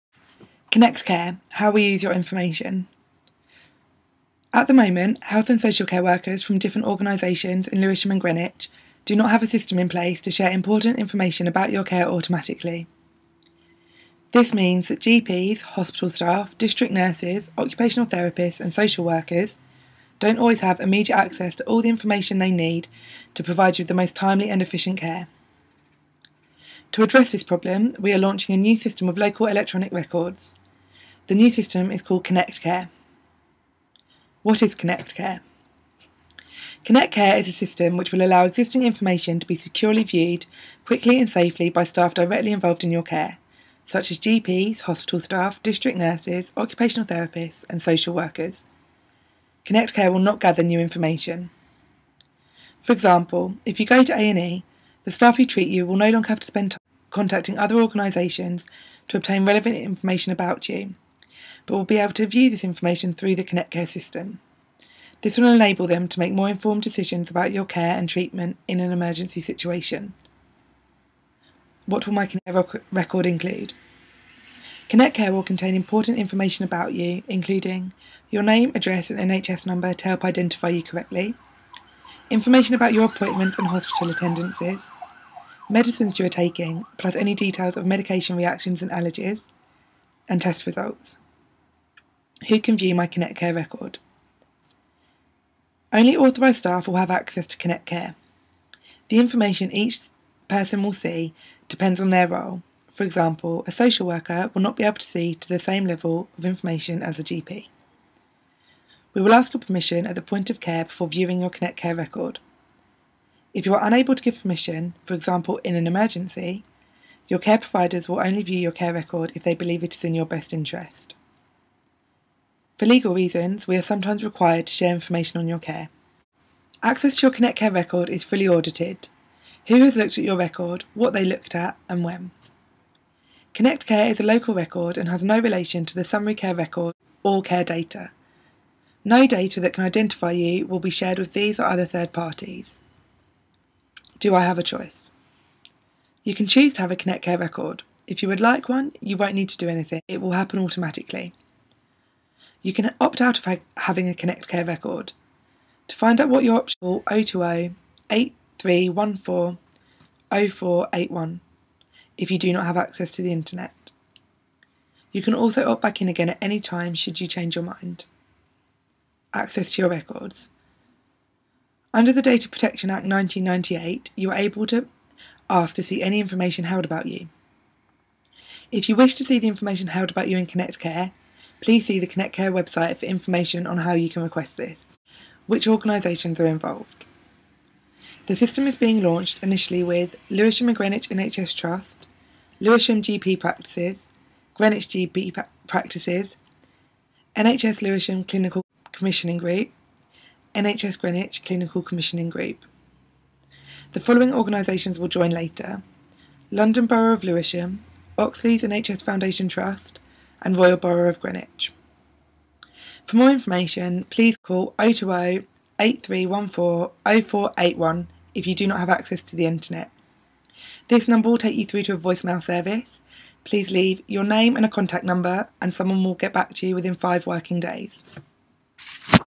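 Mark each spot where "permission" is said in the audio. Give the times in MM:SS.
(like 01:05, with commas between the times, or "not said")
01:49, 01:54.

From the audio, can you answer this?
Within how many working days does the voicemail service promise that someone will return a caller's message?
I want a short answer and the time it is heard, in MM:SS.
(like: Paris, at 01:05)
5, at 03:46.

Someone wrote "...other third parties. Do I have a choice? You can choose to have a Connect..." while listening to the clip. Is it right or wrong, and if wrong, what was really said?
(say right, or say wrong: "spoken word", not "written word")
right.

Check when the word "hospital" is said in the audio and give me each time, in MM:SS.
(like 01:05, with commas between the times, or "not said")
00:15, 00:44, 01:23.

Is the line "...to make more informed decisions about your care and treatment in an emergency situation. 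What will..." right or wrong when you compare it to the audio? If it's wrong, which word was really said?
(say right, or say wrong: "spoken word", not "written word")
right.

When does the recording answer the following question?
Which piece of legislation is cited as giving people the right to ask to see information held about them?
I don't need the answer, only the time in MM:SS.
02:52.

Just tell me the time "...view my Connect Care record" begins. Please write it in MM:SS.
01:32.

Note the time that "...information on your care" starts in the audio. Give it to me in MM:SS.
02:04.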